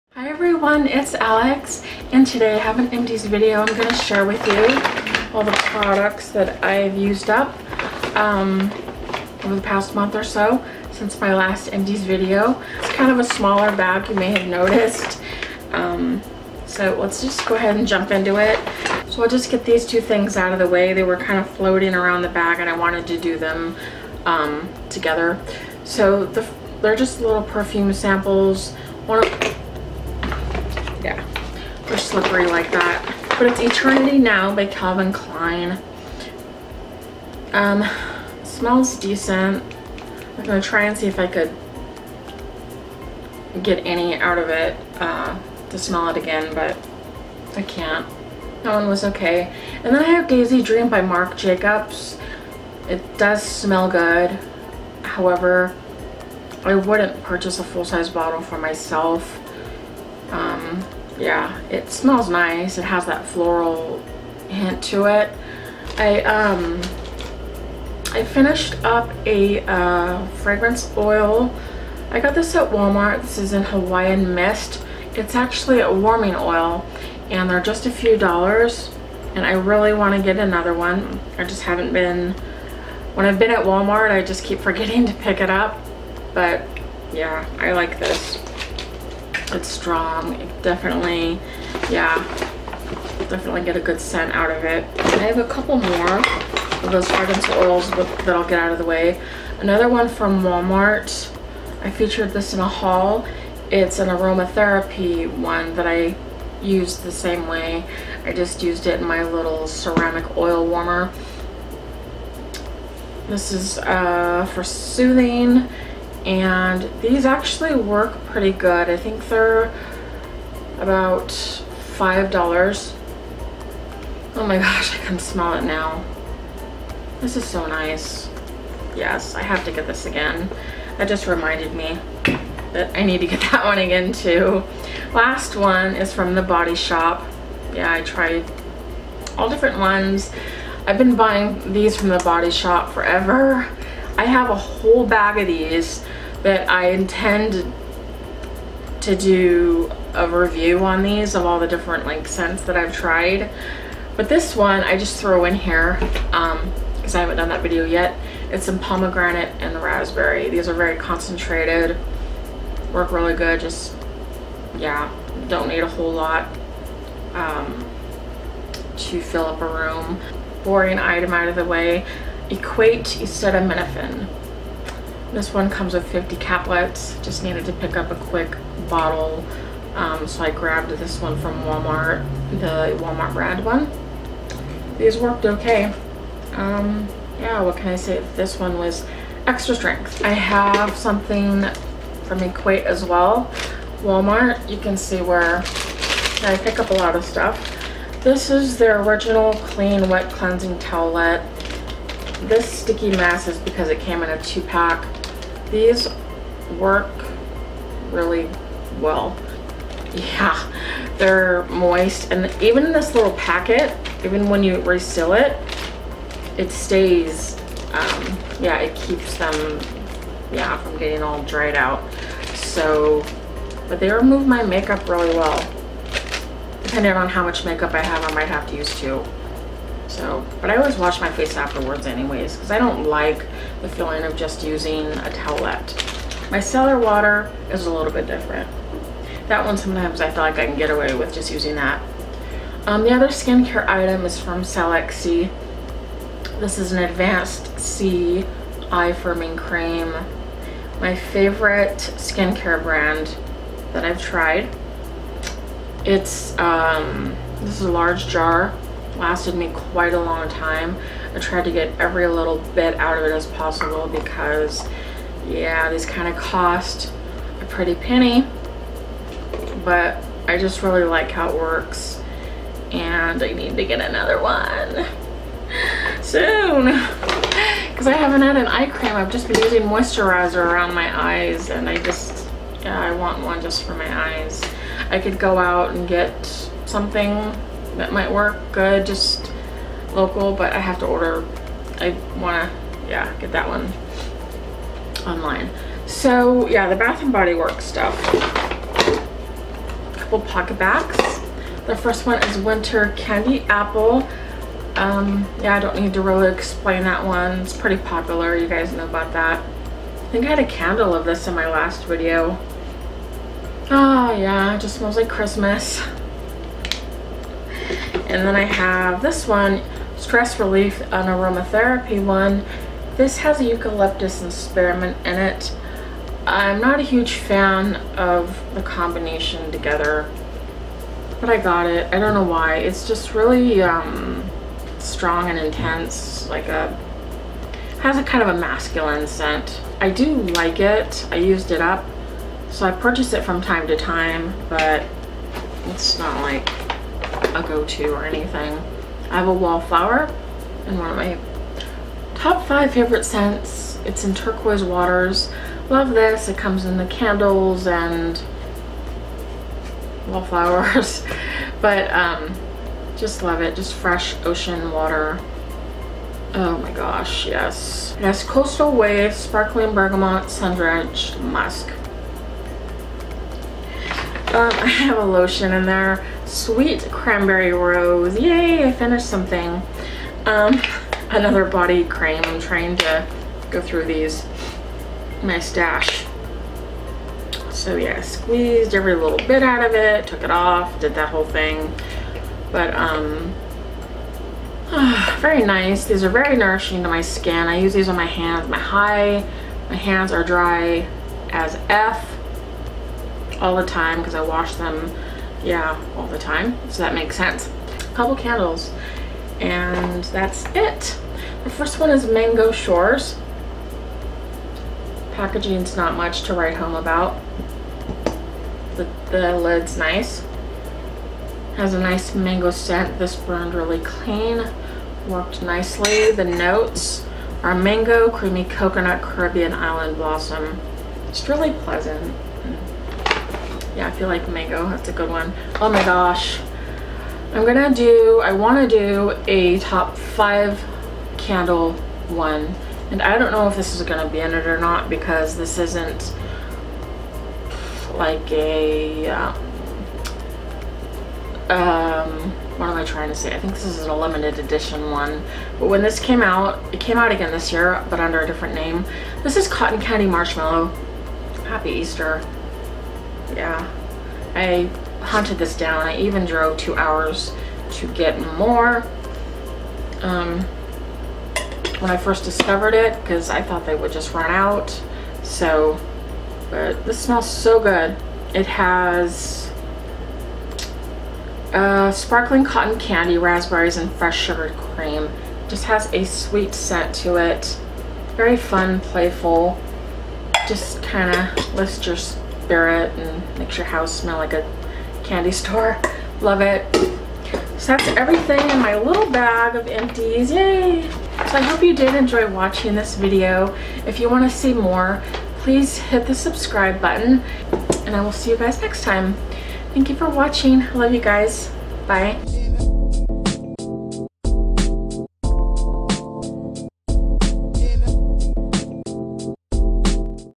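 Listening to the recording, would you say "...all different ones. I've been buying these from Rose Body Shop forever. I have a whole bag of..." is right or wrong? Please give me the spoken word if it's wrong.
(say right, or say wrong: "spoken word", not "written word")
wrong: "The", not "Rose".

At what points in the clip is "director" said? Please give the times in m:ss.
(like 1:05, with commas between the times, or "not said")
not said.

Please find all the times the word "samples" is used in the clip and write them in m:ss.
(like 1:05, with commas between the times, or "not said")
0:27.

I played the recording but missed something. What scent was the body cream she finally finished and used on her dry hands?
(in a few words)
Sweet Cranberry Rose.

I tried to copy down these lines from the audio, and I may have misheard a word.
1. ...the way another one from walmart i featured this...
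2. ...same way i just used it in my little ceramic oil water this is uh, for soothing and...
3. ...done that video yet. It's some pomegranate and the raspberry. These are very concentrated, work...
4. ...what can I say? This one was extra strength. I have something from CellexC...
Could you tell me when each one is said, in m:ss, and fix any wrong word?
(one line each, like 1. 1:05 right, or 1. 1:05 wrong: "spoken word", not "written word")
1. 1:38 right
2. 1:47 wrong: "warmer", not "water"
3. 2:37 right
4. 3:07 wrong: "Equate", not "CellexC".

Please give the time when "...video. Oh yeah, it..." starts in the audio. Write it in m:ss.
5:12.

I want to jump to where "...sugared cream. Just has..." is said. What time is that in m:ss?
8:04.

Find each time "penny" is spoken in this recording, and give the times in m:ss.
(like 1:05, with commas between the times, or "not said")
4:27.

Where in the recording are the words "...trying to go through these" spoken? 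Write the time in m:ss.
6:22.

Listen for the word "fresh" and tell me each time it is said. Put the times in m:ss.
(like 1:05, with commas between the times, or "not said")
6:03, 8:04.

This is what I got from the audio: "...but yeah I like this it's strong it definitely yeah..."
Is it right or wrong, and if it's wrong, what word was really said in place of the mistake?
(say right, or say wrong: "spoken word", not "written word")
right.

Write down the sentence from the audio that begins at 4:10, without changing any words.
My favorite skincare brand that I've tried.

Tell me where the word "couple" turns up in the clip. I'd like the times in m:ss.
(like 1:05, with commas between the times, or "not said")
1:35, 5:00, 6:48.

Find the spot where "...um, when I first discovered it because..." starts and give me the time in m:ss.
7:50.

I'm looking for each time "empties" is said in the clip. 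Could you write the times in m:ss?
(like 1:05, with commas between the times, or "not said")
0:02, 0:11, 8:19.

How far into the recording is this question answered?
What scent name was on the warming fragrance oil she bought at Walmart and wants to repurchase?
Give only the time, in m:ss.
1:13.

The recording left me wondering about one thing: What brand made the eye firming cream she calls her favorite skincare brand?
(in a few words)
Cellex-C.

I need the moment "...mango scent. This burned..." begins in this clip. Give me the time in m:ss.
7:02.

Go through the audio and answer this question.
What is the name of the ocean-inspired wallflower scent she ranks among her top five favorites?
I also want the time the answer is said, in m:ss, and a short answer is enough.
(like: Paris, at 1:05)
Turquoise Waters, at 5:54.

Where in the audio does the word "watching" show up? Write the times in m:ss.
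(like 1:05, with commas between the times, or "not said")
8:22, 8:30.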